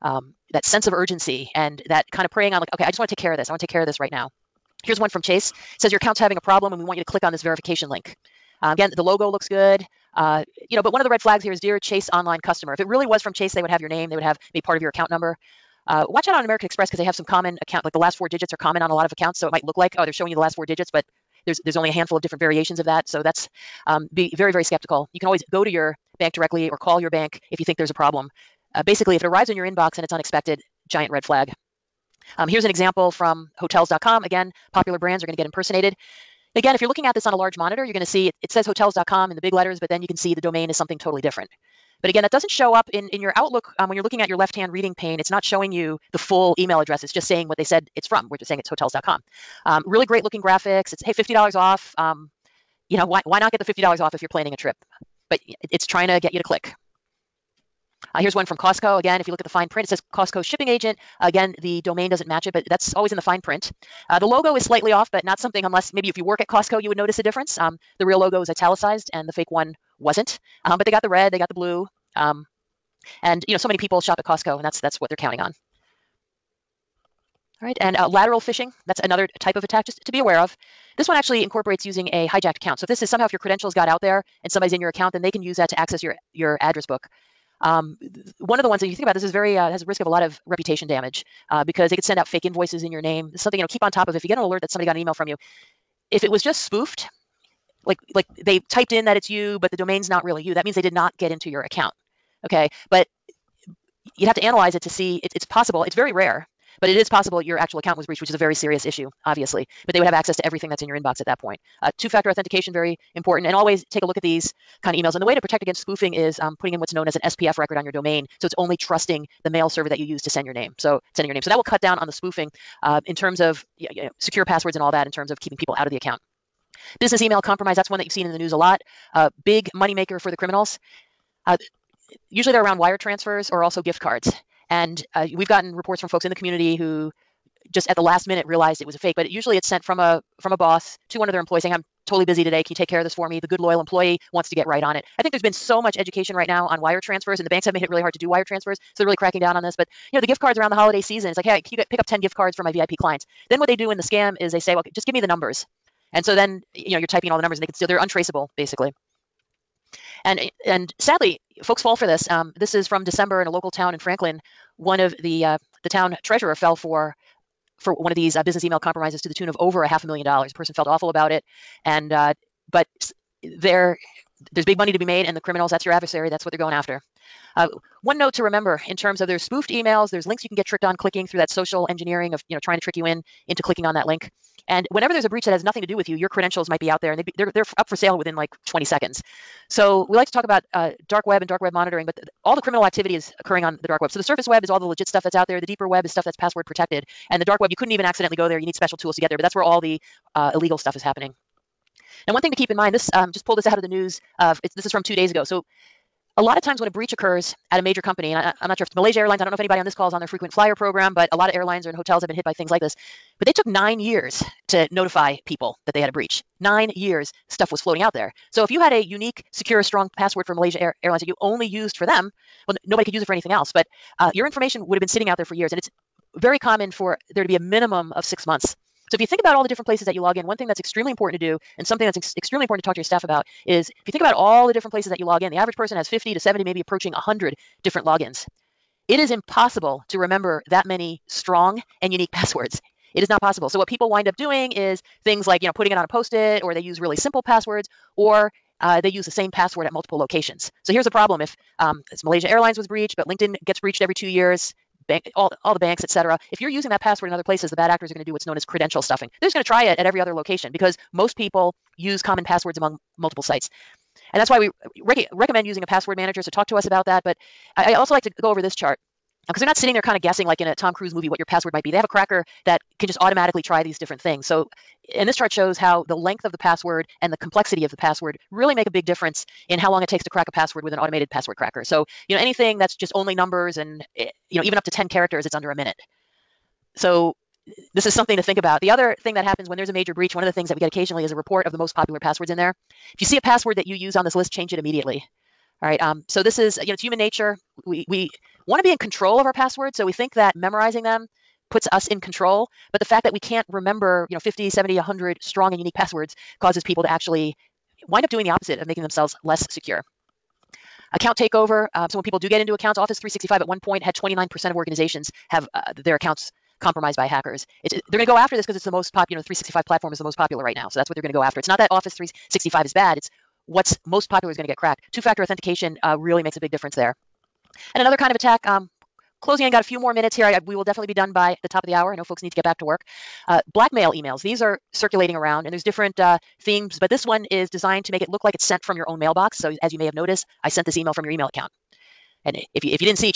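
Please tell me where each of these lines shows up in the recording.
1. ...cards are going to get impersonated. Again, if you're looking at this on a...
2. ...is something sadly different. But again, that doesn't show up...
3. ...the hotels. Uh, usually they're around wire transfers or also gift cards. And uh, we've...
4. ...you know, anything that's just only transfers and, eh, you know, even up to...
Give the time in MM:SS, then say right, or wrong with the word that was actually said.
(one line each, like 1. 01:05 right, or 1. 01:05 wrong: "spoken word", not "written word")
1. 00:34 wrong: "brands", not "cards"
2. 00:40 wrong: "totally", not "sadly"
3. 02:10 wrong: "criminals", not "hotels"
4. 04:42 wrong: "numbers", not "transfers".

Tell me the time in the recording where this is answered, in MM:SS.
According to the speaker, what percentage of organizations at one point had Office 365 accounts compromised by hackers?
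05:14.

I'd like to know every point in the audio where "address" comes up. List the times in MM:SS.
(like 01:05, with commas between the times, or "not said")
00:46, 01:26.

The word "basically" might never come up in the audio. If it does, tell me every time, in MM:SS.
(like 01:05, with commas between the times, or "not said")
00:28, 02:38.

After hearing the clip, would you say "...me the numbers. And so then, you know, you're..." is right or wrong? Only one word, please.
right.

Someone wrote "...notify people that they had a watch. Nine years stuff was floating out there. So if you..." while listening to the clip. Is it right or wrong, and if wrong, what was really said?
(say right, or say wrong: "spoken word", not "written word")
wrong: "breach", not "watch".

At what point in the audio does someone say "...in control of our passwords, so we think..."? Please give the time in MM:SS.
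04:58.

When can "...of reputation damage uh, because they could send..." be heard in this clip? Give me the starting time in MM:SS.
01:30.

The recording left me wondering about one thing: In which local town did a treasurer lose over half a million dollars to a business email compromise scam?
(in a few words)
Franklin.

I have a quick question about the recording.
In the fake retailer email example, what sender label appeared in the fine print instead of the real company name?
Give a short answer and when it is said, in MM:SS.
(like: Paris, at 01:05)
Costco shipping agent, at 01:00.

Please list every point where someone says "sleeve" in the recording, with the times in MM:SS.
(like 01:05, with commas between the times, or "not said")
not said.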